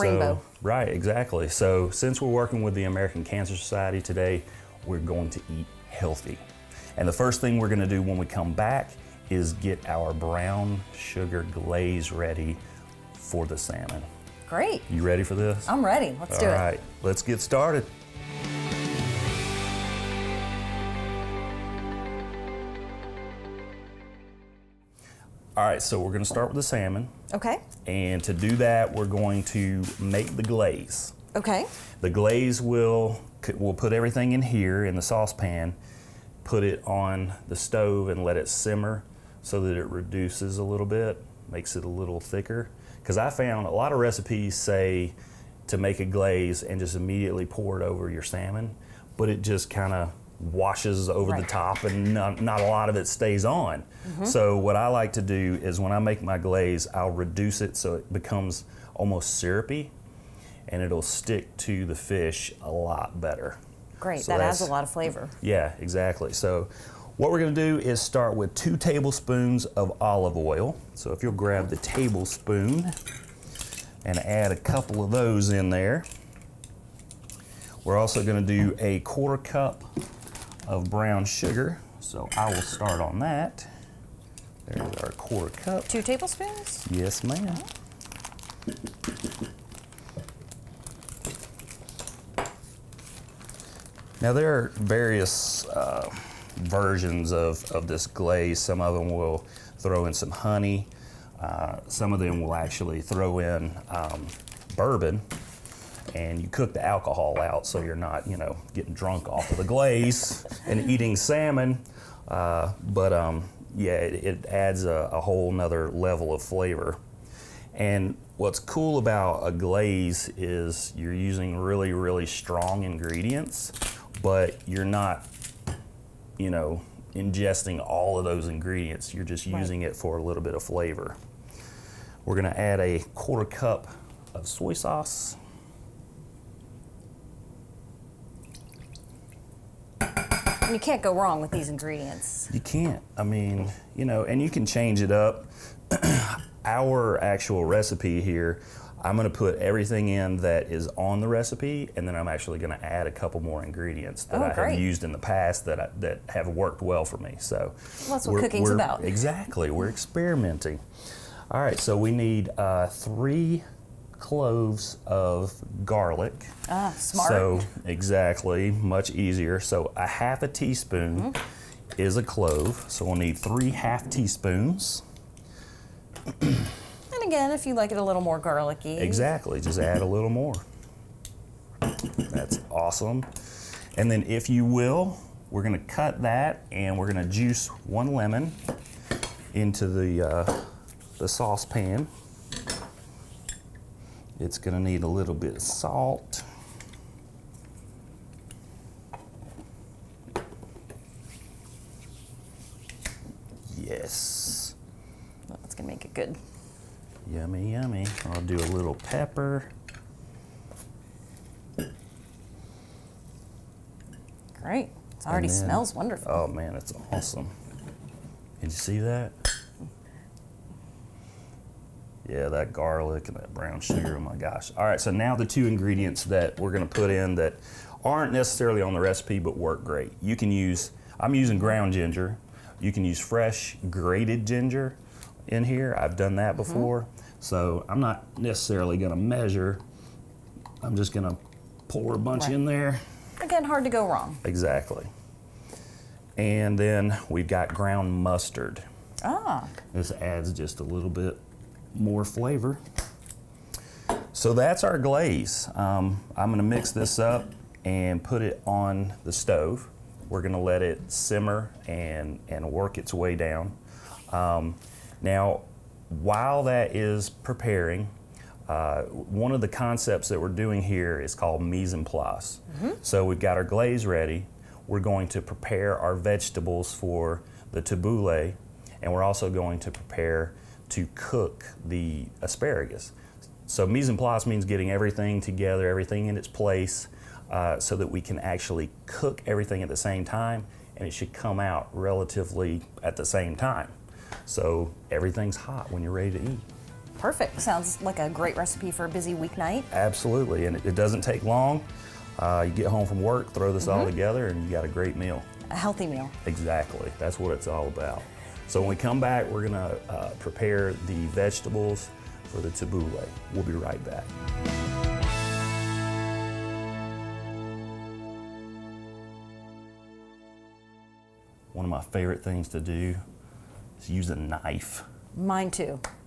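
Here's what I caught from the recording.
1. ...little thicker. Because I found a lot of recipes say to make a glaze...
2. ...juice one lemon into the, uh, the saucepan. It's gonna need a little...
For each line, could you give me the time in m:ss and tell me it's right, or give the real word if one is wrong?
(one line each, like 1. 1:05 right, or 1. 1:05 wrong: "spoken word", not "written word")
1. 0:41 right
2. 3:07 right.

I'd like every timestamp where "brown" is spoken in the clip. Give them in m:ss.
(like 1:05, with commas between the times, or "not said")
0:10, 1:20, 3:43.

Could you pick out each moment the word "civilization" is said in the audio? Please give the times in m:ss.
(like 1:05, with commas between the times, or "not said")
not said.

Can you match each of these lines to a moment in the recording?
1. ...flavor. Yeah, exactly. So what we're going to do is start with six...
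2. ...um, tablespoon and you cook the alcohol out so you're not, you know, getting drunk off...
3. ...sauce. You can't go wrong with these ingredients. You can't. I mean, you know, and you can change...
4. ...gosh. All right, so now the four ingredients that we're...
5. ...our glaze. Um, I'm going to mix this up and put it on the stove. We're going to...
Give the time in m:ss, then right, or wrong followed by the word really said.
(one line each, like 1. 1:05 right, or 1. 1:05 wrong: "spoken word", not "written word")
1. 1:04 wrong: "two", not "six"
2. 1:43 wrong: "bourbon", not "tablespoon"
3. 2:14 right
4. 3:44 wrong: "two", not "four"
5. 4:14 right.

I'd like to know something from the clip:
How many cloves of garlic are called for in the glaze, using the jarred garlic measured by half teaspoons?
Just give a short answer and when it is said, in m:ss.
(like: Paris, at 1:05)
3, at 2:42.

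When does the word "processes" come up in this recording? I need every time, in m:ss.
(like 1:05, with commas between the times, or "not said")
not said.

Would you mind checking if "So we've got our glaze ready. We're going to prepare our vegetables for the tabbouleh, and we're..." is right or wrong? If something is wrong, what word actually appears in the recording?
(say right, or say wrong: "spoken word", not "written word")
right.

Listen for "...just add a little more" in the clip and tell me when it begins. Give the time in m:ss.
2:59.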